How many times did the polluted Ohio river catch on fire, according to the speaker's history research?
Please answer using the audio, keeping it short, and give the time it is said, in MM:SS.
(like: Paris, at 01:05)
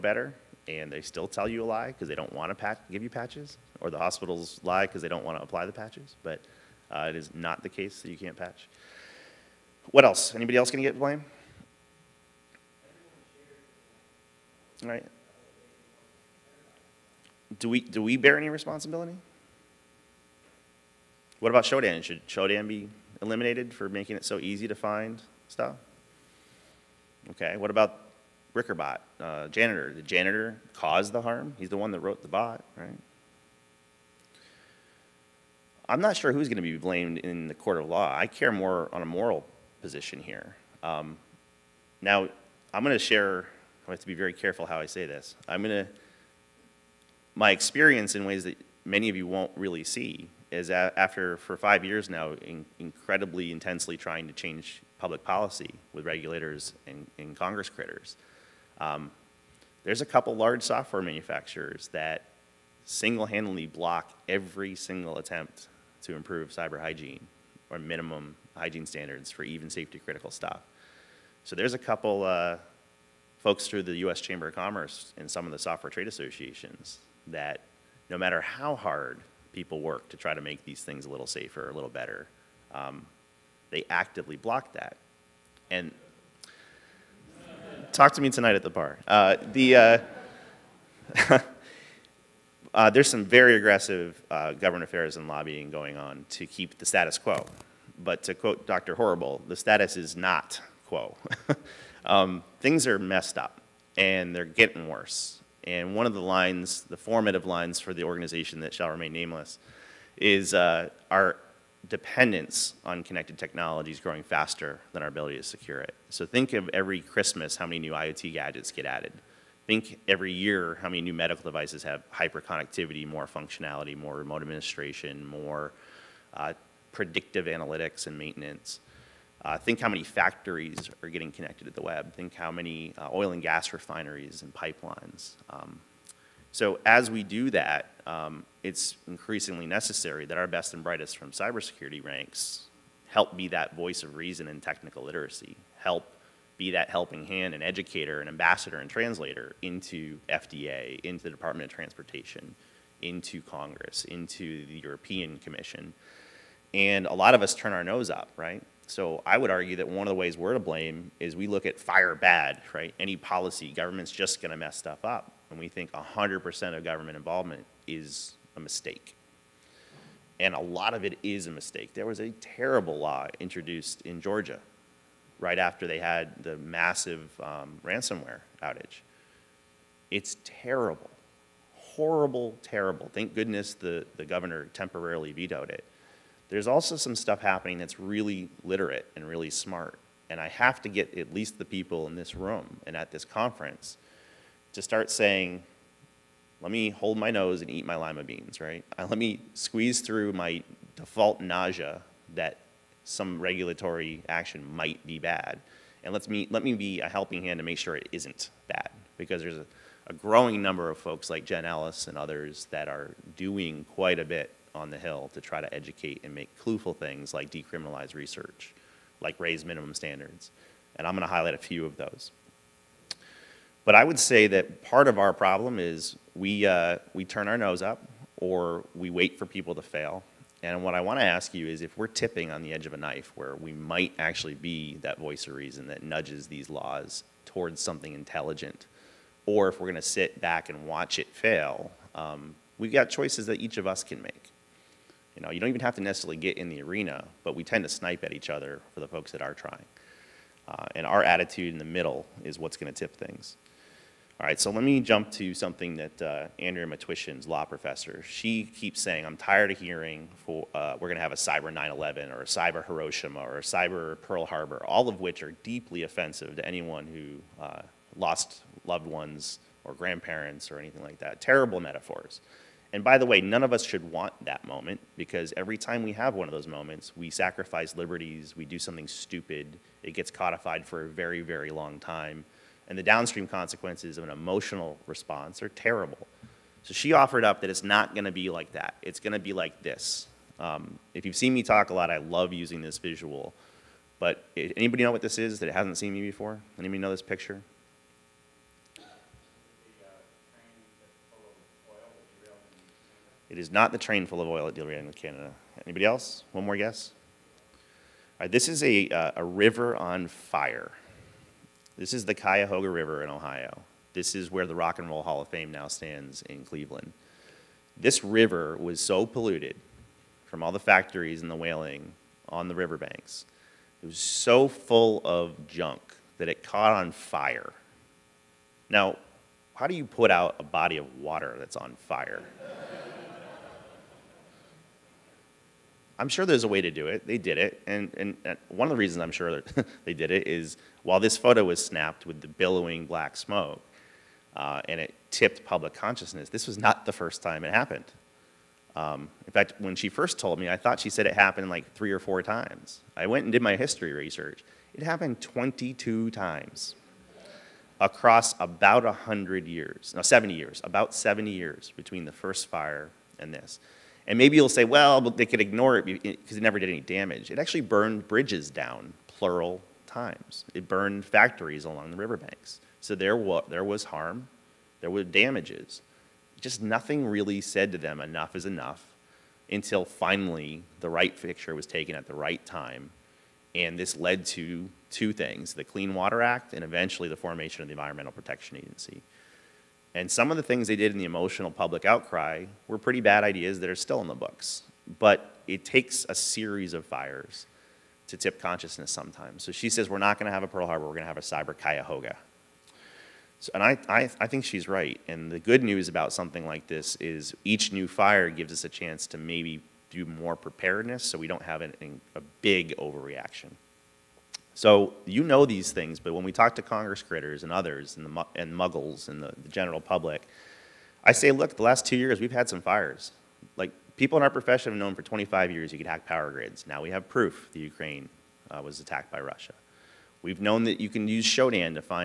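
22, at 05:55.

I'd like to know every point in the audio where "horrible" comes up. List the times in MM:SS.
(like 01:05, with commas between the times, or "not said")
01:38, 03:01.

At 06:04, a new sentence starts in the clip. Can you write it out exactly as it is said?
And maybe you'll say, well, they could ignore it because it never did any damage.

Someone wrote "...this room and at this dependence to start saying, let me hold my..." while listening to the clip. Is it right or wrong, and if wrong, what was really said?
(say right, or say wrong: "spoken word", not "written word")
wrong: "conference", not "dependence".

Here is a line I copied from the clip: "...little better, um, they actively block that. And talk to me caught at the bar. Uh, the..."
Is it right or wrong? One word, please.
wrong.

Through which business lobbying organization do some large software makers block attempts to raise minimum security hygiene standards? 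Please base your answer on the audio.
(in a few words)
U.S. Chamber of Commerce.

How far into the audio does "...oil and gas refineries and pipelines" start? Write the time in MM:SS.
02:13.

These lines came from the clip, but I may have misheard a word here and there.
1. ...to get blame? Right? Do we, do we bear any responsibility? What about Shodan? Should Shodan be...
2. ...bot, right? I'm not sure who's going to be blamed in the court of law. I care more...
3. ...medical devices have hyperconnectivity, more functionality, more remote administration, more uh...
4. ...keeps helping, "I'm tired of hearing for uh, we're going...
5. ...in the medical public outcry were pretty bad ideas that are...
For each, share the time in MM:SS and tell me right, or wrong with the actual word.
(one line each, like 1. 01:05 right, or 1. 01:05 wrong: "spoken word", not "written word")
1. 00:10 right
2. 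00:32 right
3. 02:01 right
4. 04:18 wrong: "saying", not "helping"
5. 06:31 wrong: "emotional", not "medical".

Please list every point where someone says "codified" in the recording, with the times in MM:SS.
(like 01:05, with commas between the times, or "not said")
04:40.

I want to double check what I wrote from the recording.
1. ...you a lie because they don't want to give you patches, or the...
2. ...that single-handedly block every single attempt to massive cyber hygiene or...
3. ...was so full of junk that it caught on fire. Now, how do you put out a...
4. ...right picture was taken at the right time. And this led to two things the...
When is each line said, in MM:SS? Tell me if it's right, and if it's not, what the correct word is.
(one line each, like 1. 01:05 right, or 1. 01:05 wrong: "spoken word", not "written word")
1. 00:01 right
2. 01:01 wrong: "improve", not "massive"
3. 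05:24 right
4. 06:21 right.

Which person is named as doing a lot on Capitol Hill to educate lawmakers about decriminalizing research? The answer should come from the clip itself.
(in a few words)
Jen Ellis.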